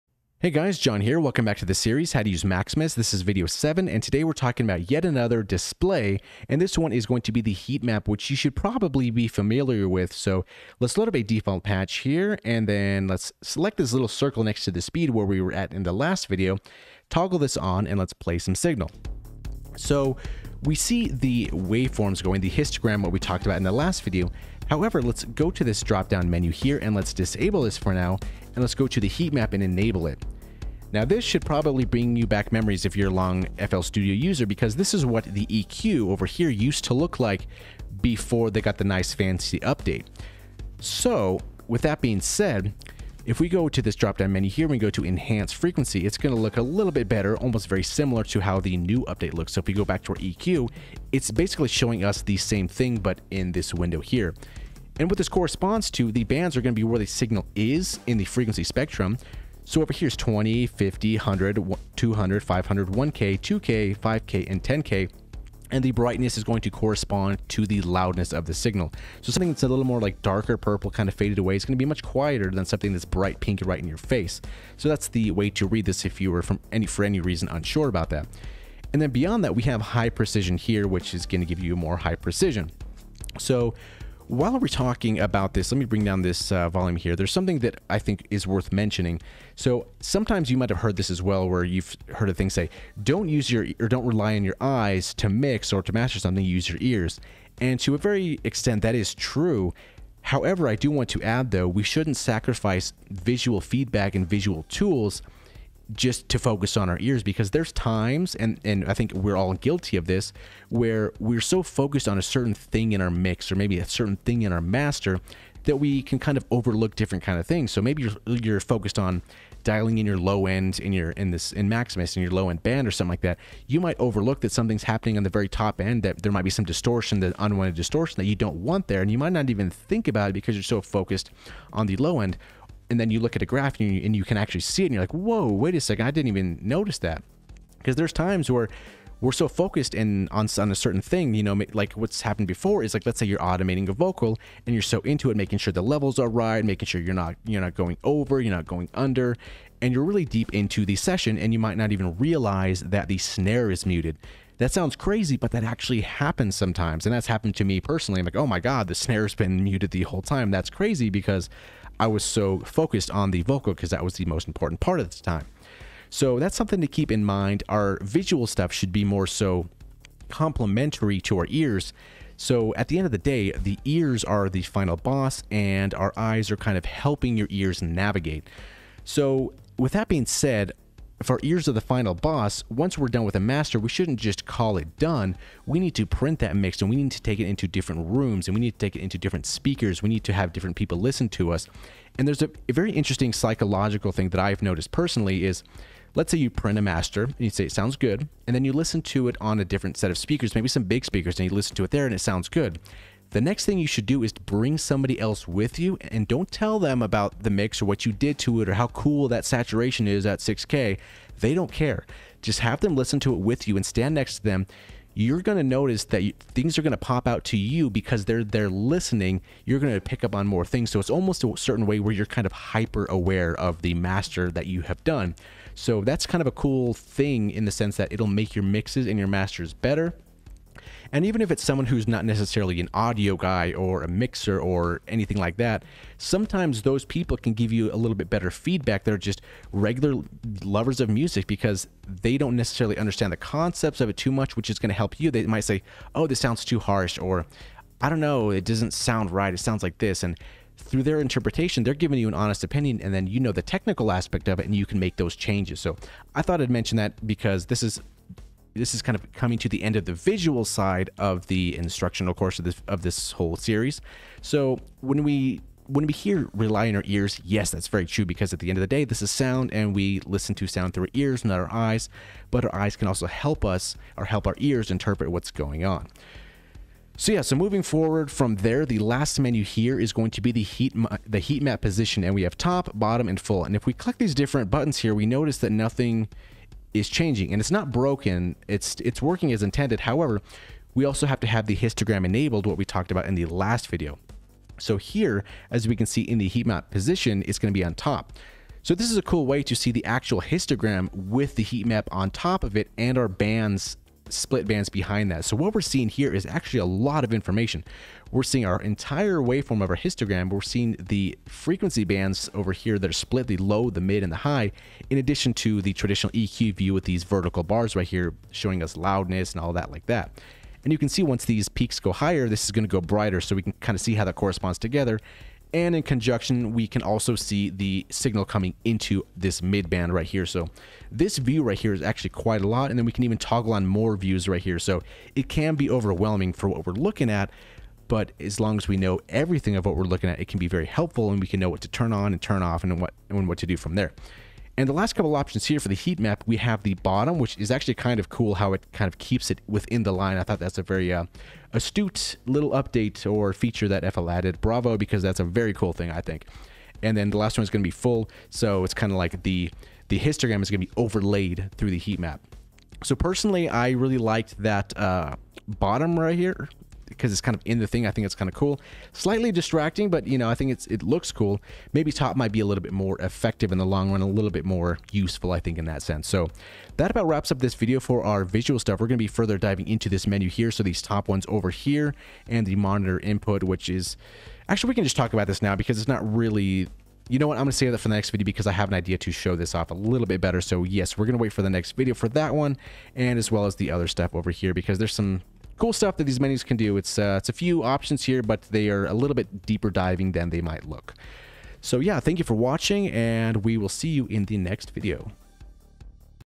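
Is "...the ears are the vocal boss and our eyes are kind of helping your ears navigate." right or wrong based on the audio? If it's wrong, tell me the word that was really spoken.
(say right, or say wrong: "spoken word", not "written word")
wrong: "final", not "vocal".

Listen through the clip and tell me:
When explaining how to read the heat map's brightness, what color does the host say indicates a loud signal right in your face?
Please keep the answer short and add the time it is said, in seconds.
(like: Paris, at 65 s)
Bright pink, at 73 s.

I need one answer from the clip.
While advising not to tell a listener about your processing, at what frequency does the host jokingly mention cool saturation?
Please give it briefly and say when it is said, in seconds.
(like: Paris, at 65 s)
6K, at 210 s.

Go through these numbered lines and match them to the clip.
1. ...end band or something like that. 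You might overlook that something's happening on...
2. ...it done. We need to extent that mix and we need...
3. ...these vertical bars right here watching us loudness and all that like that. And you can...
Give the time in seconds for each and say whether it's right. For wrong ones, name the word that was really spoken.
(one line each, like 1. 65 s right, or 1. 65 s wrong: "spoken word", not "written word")
1. 122 s right
2. 184 s wrong: "print", not "extent"
3. 317 s wrong: "showing", not "watching".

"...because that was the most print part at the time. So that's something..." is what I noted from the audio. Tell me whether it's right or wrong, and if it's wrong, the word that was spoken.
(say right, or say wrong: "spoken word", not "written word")
wrong: "important", not "print".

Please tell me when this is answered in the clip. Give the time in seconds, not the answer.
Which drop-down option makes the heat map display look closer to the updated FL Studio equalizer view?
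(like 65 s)
45 s.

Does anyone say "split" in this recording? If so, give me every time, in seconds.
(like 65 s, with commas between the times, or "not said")
304 s, 313 s.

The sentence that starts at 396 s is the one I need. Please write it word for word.
It's, uh, it's a few options here, but they are a little bit deeper diving than they might look.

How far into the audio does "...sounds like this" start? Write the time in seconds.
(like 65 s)
249 s.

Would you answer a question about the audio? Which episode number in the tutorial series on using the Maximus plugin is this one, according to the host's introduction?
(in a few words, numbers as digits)
7.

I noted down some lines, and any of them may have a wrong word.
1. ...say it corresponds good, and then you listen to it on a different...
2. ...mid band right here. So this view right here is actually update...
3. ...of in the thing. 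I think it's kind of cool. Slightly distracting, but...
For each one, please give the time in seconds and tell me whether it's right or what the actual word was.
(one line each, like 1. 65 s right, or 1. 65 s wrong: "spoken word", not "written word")
1. 197 s wrong: "sounds", not "corresponds"
2. 329 s wrong: "quite", not "update"
3. 367 s right.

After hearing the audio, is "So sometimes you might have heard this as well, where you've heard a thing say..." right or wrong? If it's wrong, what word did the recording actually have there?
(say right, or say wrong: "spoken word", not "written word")
right.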